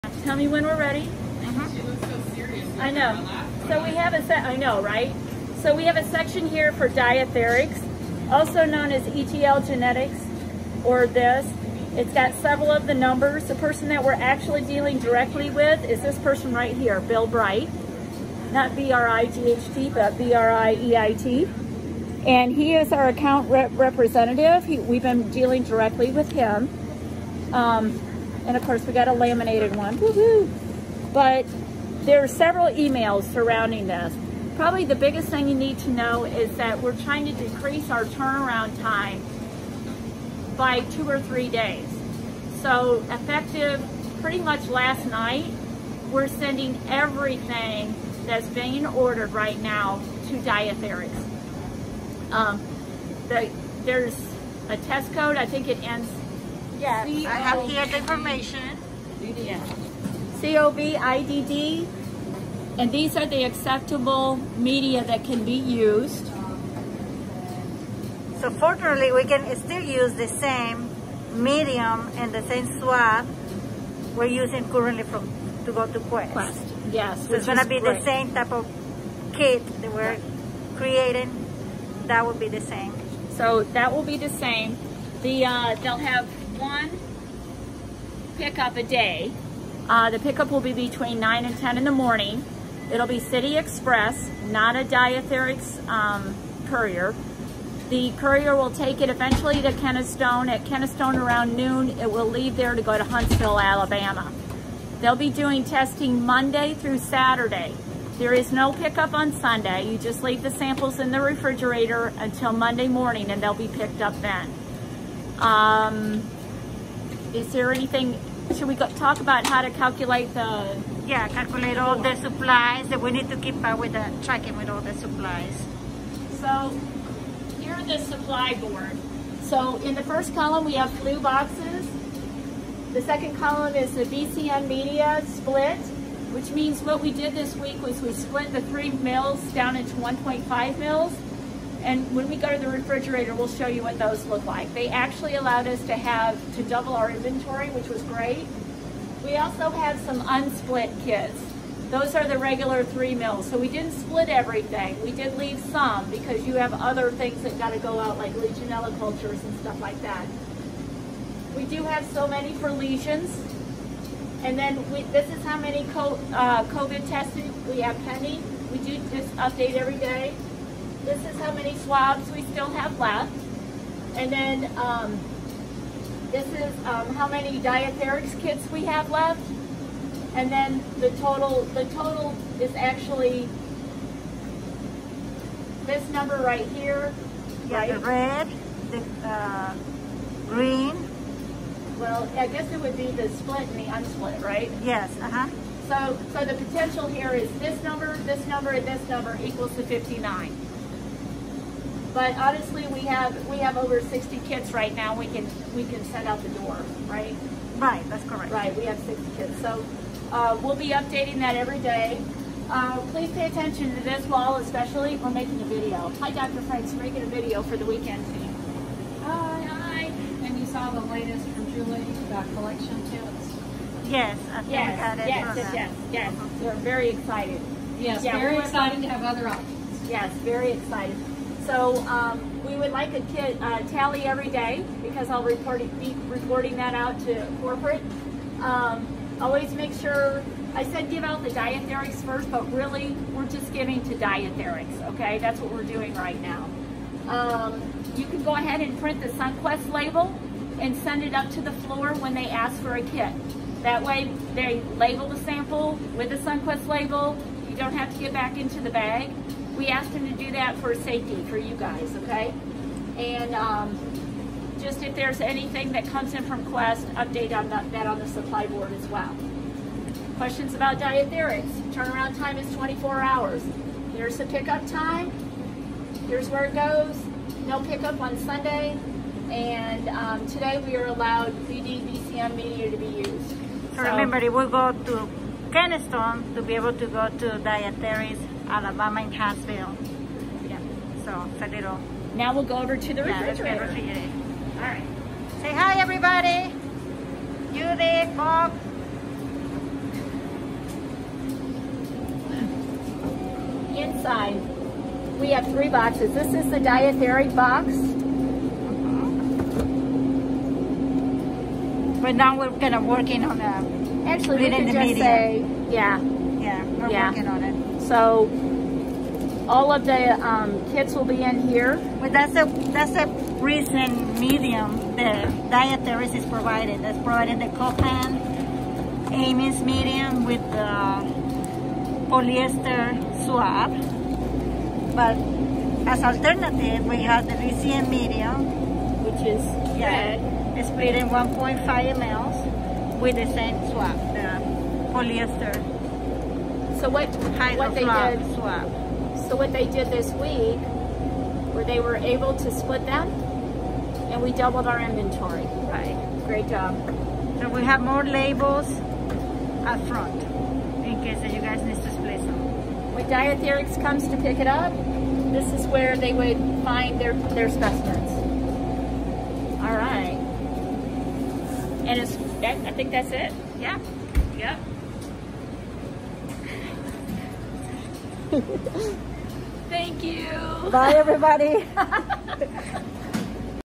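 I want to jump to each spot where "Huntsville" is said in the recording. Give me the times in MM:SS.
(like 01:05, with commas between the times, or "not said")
01:43, 04:49.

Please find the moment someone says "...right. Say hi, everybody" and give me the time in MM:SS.
04:54.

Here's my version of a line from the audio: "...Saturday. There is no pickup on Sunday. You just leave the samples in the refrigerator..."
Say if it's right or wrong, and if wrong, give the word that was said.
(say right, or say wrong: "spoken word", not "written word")
right.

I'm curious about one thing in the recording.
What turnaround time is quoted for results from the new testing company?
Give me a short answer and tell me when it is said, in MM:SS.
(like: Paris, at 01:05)
24 hours, at 04:32.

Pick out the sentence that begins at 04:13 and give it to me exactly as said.
That way they label the sample with the SunQuest label.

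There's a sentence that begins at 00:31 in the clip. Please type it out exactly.
But there are several emails surrounding this.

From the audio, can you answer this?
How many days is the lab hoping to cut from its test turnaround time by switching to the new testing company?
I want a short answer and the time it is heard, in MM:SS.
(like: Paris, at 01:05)
two or three days, at 00:40.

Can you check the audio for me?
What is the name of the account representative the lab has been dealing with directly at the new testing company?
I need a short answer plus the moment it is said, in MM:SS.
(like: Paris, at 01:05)
Bill, at 00:17.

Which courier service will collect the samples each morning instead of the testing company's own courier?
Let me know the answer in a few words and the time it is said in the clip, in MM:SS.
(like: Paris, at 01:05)
City Express, at 01:33.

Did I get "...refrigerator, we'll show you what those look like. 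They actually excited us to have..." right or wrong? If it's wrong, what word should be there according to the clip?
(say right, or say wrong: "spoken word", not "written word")
wrong: "allowed", not "excited".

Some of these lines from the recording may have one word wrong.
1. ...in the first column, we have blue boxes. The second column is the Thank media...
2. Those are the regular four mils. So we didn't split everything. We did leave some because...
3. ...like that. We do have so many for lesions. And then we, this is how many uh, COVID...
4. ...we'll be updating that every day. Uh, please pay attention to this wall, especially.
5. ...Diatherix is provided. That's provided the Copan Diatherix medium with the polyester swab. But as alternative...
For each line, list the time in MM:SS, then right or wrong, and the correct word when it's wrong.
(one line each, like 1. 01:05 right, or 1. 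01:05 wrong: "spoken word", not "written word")
1. 02:09 wrong: "VCM", not "Thank"
2. 02:31 wrong: "three", not "four"
3. 02:39 right
4. 03:30 right
5. 05:25 wrong: "Amies", not "Diatherix".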